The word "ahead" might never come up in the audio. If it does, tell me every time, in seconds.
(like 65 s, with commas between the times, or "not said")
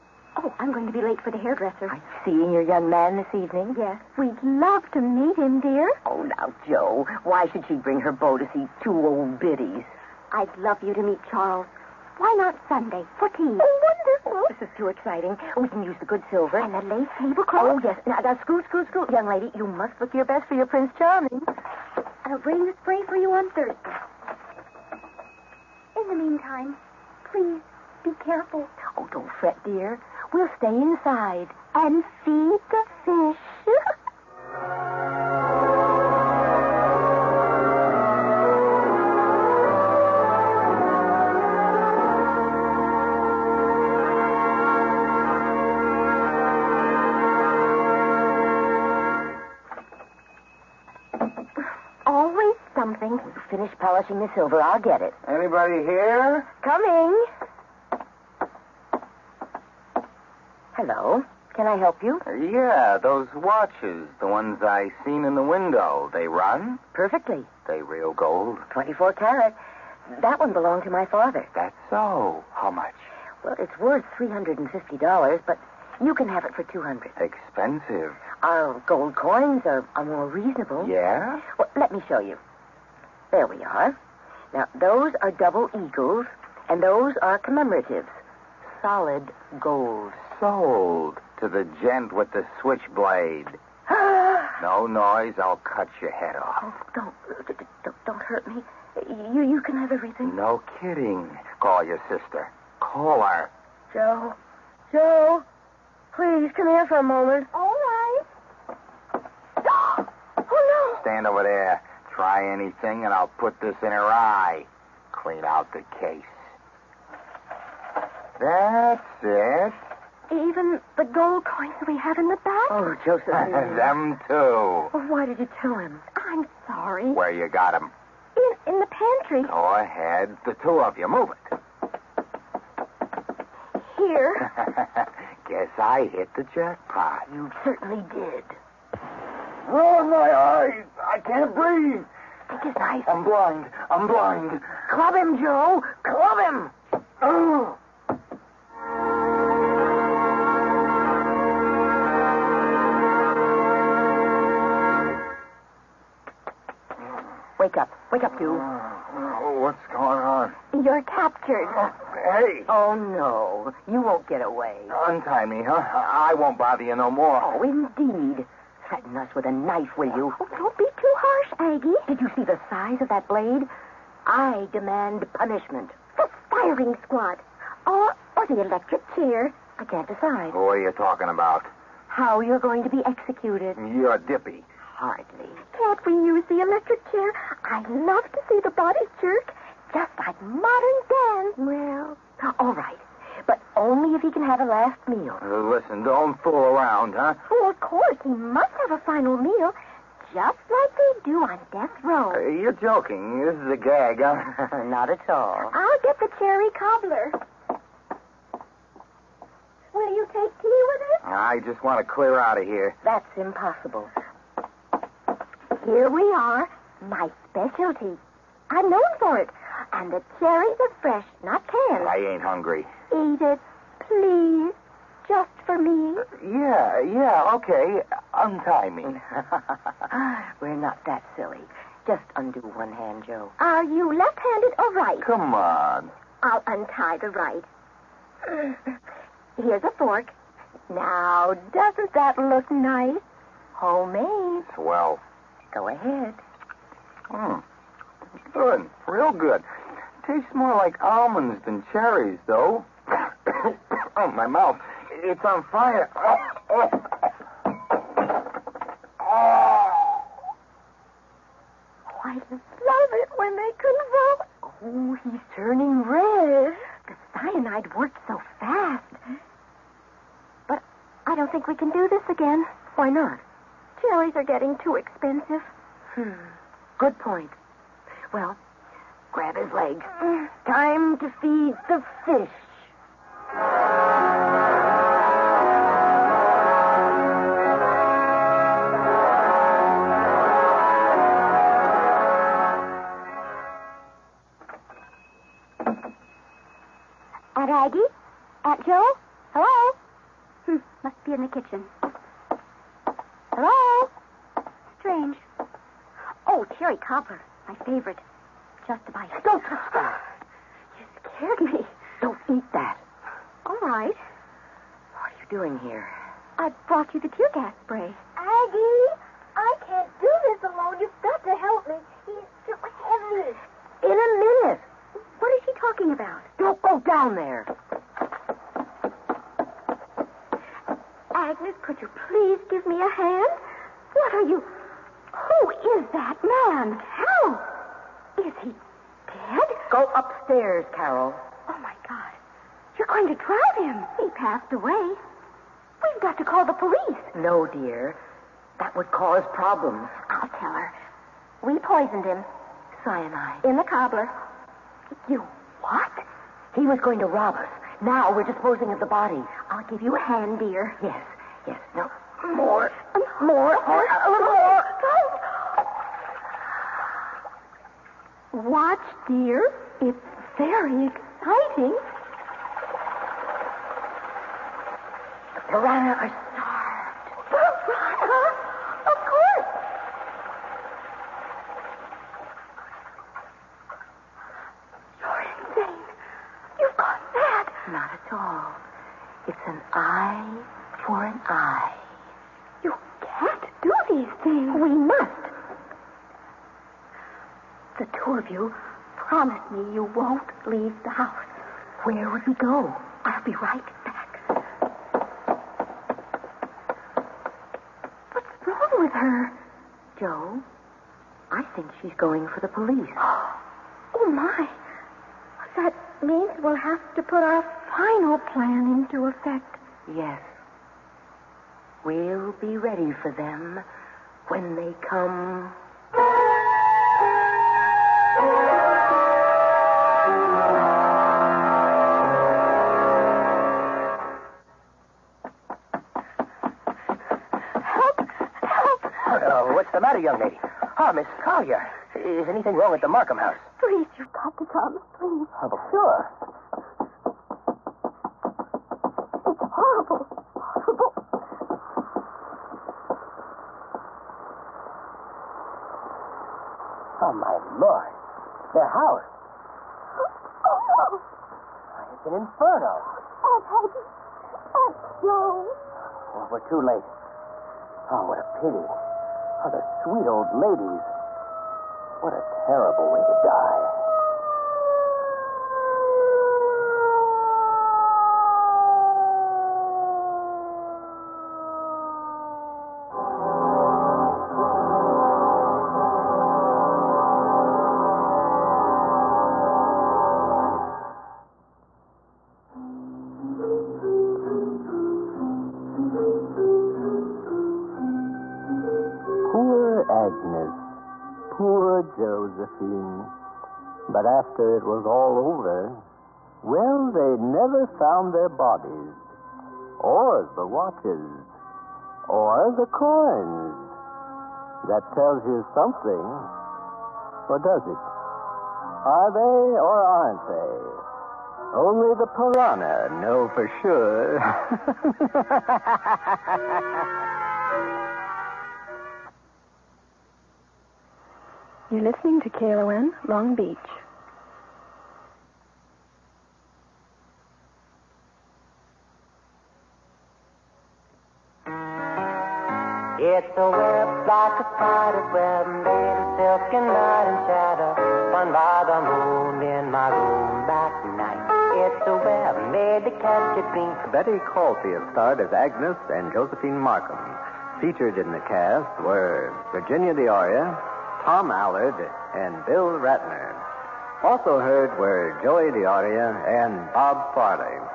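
129 s, 245 s.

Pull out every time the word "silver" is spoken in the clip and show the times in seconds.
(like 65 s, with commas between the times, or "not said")
16 s, 54 s.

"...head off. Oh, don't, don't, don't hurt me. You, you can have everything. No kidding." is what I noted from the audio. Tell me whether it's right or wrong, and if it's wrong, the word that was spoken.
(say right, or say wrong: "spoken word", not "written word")
right.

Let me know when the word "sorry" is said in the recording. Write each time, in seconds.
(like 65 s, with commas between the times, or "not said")
126 s.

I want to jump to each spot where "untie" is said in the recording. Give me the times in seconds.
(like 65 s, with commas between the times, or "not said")
165 s, 228 s, 236 s.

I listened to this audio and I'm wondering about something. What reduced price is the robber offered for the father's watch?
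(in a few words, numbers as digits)
200.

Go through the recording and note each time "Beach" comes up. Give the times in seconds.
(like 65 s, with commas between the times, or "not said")
533 s.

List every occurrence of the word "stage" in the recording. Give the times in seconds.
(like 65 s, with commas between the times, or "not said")
not said.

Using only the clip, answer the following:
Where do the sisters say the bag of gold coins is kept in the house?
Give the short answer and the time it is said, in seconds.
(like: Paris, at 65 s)
the pantry, at 128 s.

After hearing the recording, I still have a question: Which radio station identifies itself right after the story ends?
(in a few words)
KLON.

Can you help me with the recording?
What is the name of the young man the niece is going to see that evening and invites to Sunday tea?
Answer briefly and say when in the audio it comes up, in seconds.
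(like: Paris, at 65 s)
Charles, at 11 s.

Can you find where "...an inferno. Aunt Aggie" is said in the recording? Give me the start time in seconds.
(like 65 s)
462 s.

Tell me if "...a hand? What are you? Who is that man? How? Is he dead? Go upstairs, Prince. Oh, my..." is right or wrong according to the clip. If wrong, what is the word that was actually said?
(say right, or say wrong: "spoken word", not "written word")
wrong: "Carol", not "Prince".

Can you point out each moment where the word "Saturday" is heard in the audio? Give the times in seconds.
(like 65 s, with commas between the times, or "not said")
not said.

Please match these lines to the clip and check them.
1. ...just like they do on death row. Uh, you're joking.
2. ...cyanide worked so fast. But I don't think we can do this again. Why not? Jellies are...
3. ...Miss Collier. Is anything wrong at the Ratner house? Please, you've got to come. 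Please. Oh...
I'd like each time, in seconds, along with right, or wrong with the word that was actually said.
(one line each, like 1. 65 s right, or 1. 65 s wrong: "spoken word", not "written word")
1. 200 s right
2. 267 s right
3. 441 s wrong: "Markham", not "Ratner".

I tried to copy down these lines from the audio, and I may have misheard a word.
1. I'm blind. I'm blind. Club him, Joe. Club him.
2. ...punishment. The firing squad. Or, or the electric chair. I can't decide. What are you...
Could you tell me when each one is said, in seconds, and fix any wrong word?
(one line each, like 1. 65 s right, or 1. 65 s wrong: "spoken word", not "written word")
1. 143 s right
2. 175 s right.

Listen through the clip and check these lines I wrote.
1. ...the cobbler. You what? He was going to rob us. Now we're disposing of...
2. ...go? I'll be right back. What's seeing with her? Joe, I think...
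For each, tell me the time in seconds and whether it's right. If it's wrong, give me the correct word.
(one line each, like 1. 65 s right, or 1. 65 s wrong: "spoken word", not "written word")
1. 353 s right
2. 402 s wrong: "wrong", not "seeing".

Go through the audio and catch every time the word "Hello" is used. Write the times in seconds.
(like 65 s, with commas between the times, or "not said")
60 s, 299 s, 303 s.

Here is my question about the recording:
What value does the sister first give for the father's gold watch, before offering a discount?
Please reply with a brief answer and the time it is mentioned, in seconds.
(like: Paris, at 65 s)
$350, at 74 s.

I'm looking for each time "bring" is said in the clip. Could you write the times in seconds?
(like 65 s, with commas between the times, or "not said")
7 s, 22 s.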